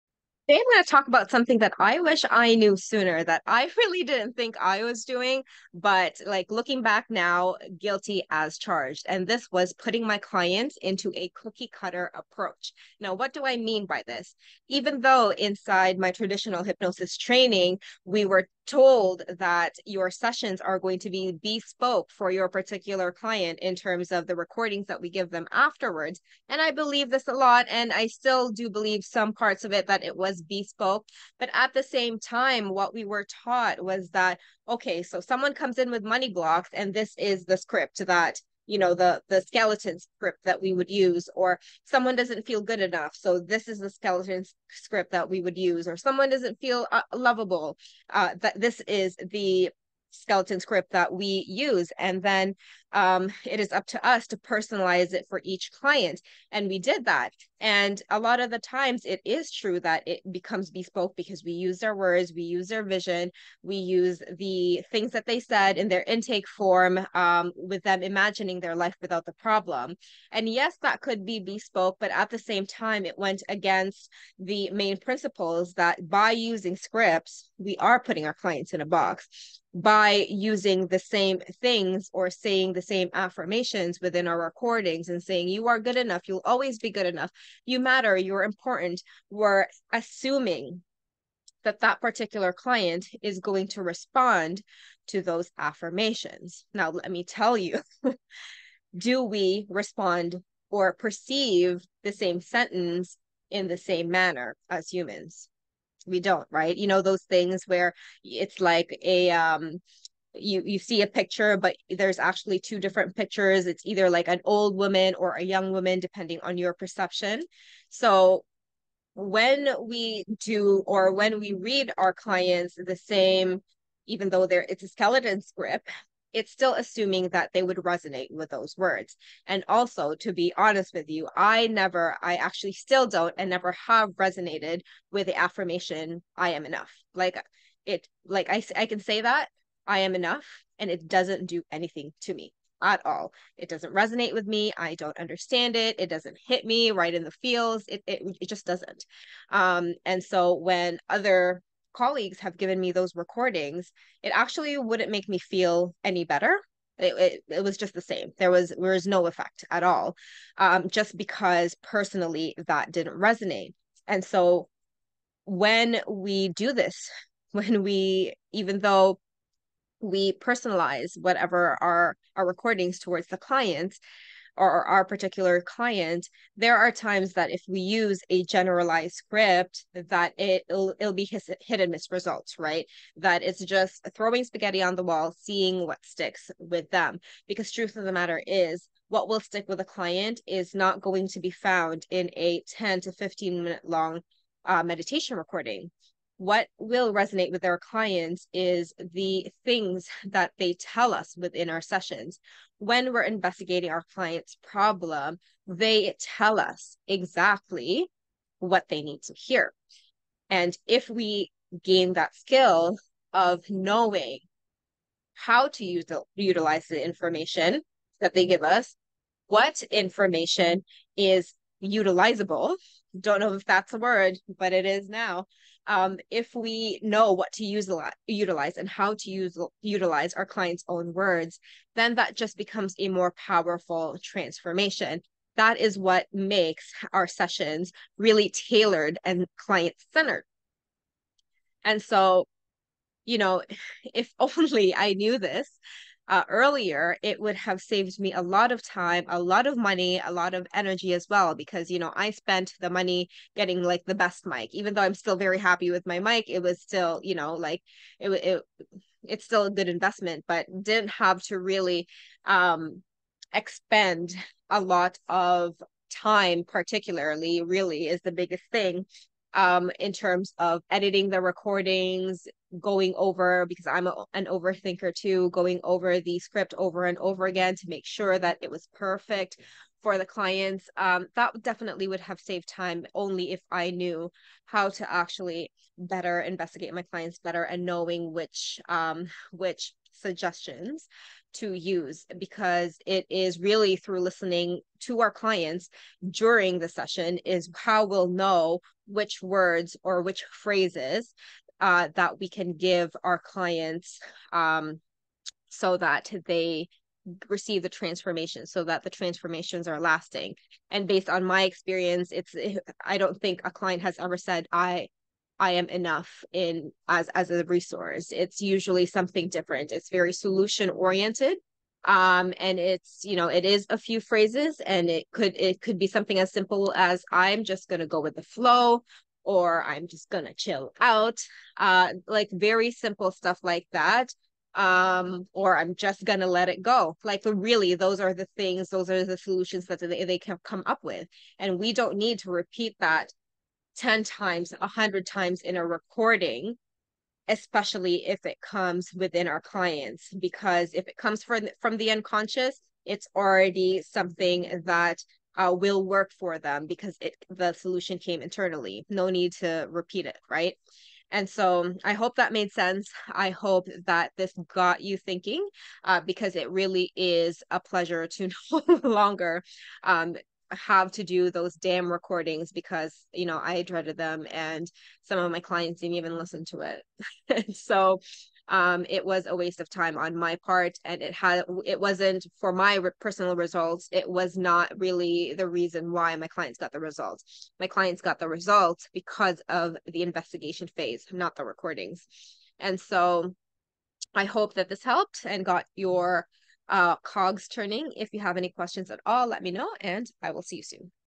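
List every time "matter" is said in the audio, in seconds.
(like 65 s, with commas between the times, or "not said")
87 s, 188 s.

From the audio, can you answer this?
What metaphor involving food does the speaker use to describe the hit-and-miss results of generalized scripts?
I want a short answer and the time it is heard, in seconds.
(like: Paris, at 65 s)
throwing spaghetti on the wall, at 184 s.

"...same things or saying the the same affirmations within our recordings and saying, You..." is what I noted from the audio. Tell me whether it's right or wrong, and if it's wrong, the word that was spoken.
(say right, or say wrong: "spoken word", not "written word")
right.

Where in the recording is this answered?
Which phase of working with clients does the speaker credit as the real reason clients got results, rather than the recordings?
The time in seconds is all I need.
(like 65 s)
390 s.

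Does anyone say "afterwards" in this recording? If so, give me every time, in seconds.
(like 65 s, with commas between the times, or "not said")
25 s.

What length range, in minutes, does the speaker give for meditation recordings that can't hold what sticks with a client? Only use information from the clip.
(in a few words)
10 to 15.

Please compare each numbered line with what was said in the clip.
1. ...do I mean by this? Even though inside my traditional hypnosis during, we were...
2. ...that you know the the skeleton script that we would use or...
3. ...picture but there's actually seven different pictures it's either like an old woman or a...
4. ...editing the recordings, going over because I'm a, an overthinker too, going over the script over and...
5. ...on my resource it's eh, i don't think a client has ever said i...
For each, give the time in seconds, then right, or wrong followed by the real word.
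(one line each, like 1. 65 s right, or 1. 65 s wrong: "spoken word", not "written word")
1. 13 s wrong: "training", not "during"
2. 38 s right
3. 111 s wrong: "two", not "seven"
4. 270 s right
5. 311 s wrong: "experience", not "resource".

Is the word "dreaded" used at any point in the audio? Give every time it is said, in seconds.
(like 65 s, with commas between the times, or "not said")
373 s.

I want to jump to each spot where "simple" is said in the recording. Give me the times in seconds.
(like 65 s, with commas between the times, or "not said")
326 s, 332 s.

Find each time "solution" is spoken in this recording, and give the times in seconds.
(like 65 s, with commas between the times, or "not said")
320 s, 339 s, 357 s.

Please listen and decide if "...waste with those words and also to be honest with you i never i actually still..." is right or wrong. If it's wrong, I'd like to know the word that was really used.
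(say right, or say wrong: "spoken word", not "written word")
wrong: "resonate", not "waste".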